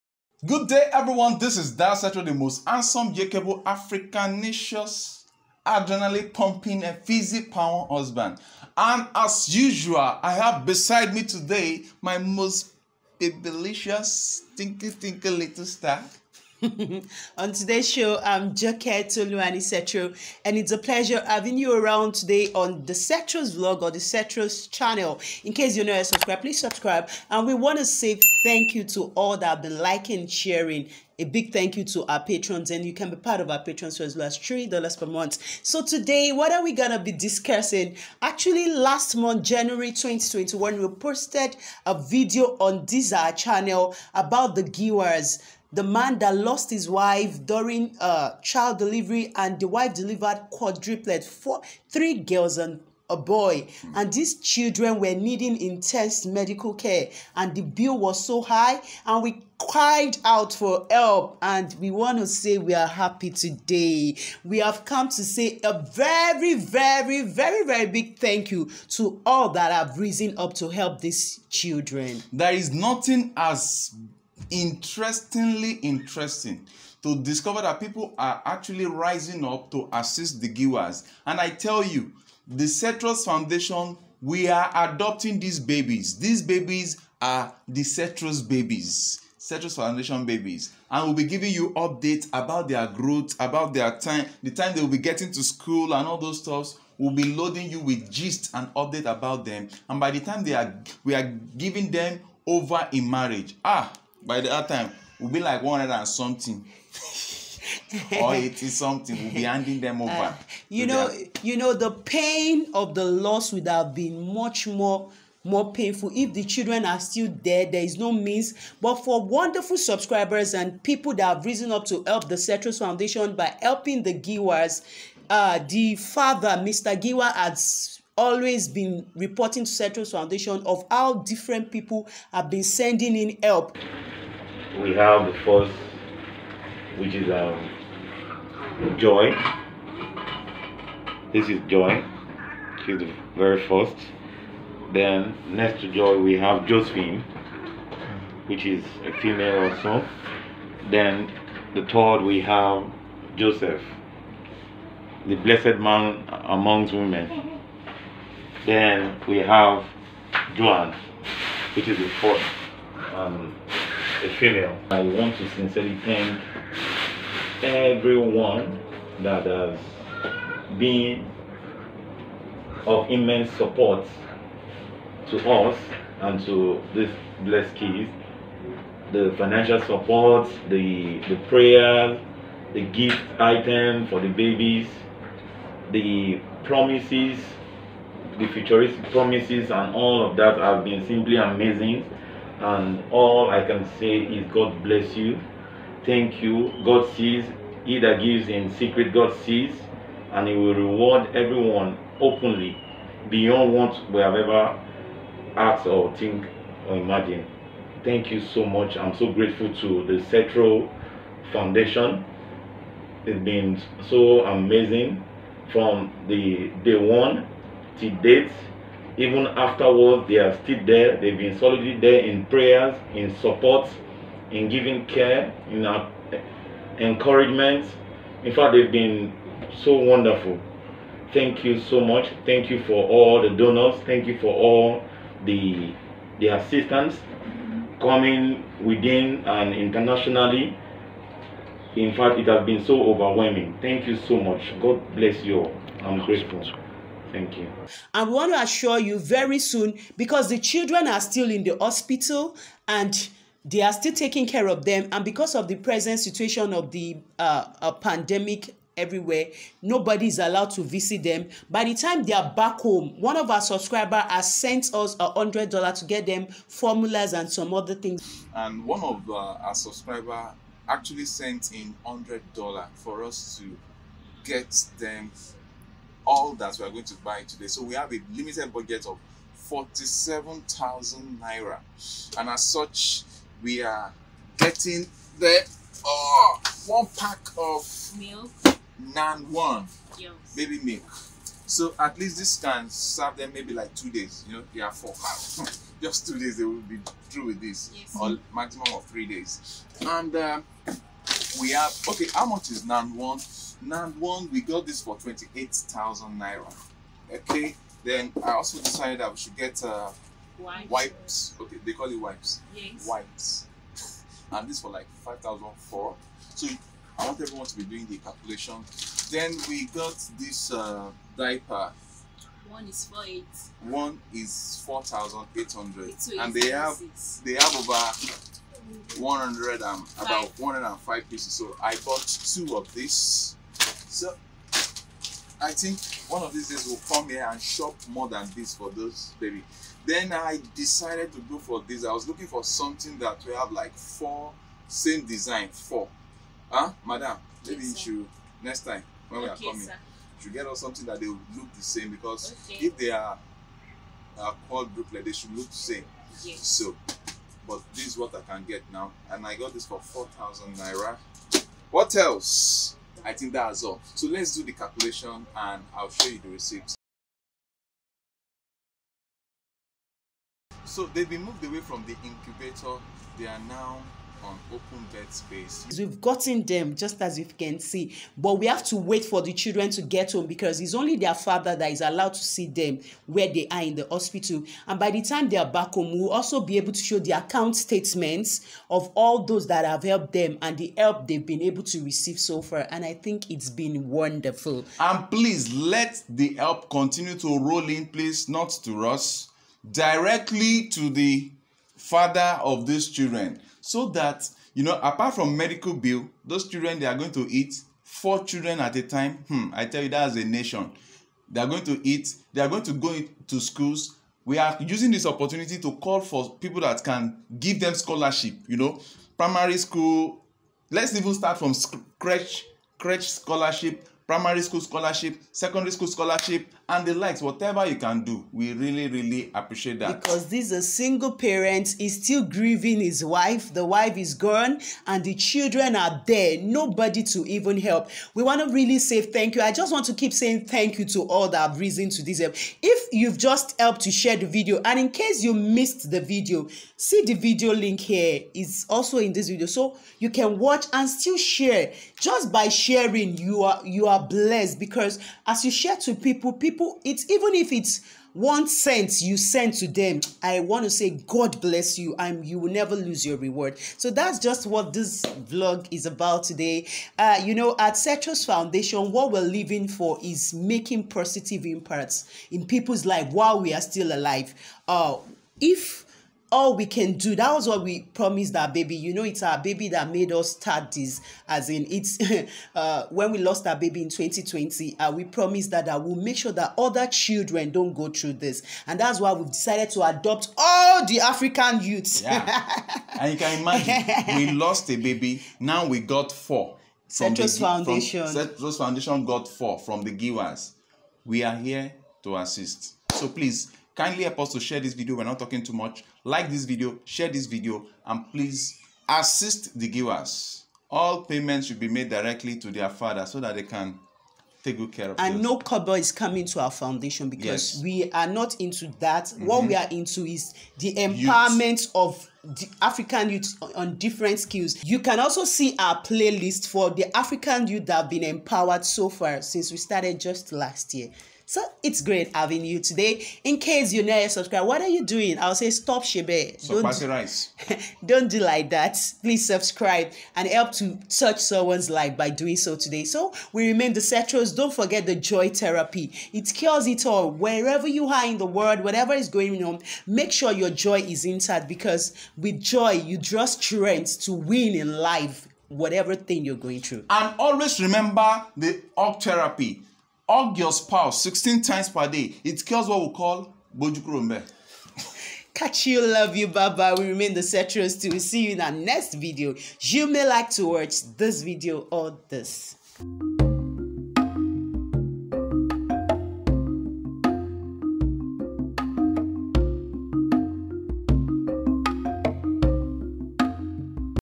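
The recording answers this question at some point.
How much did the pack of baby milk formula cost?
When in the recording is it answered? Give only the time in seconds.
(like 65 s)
305 s.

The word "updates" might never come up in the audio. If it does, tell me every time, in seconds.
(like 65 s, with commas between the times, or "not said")
91 s, 98 s.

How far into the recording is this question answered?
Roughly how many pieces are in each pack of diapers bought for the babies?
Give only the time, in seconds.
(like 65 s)
330 s.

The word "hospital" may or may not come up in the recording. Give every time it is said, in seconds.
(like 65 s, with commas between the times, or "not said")
251 s, 384 s.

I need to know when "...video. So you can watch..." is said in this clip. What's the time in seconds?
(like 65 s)
449 s.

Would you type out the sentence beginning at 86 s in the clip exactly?
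These babies are the Cetros babies.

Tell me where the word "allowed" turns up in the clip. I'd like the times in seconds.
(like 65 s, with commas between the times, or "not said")
260 s, 382 s.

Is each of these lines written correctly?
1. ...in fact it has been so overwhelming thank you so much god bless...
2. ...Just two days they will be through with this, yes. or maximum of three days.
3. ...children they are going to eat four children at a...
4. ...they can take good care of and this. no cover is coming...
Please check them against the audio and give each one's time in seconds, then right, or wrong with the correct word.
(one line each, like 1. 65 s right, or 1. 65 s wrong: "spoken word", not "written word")
1. 241 s right
2. 296 s right
3. 406 s right
4. 513 s right.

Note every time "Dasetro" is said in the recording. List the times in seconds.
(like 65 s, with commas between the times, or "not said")
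1 s.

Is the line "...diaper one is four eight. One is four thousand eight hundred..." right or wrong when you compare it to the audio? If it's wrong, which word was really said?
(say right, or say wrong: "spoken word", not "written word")
right.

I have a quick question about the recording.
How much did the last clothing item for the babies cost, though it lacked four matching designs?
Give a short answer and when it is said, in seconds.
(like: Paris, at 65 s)
4,000 naira, at 359 s.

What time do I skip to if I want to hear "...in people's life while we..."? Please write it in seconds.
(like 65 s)
472 s.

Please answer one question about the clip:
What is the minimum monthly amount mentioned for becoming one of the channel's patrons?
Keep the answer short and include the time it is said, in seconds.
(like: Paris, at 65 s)
3 dollars, at 34 s.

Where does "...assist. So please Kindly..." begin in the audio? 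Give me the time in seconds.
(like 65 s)
502 s.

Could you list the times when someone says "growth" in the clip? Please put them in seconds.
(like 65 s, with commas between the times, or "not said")
92 s.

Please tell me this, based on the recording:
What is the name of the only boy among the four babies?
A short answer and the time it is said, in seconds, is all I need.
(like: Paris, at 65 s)
Joseph, at 153 s.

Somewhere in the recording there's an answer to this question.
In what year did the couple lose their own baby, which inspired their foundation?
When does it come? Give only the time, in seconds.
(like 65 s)
484 s.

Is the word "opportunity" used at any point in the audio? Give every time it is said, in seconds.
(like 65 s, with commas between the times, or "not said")
415 s.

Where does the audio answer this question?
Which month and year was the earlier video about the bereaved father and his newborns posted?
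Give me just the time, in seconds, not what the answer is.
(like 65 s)
39 s.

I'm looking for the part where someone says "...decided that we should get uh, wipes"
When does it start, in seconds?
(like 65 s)
308 s.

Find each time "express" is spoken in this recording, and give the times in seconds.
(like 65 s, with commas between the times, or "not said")
not said.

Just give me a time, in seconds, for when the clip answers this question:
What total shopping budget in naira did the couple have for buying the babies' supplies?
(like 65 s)
279 s.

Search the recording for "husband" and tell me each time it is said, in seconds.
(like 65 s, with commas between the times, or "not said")
7 s.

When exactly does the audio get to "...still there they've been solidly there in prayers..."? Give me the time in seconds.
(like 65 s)
220 s.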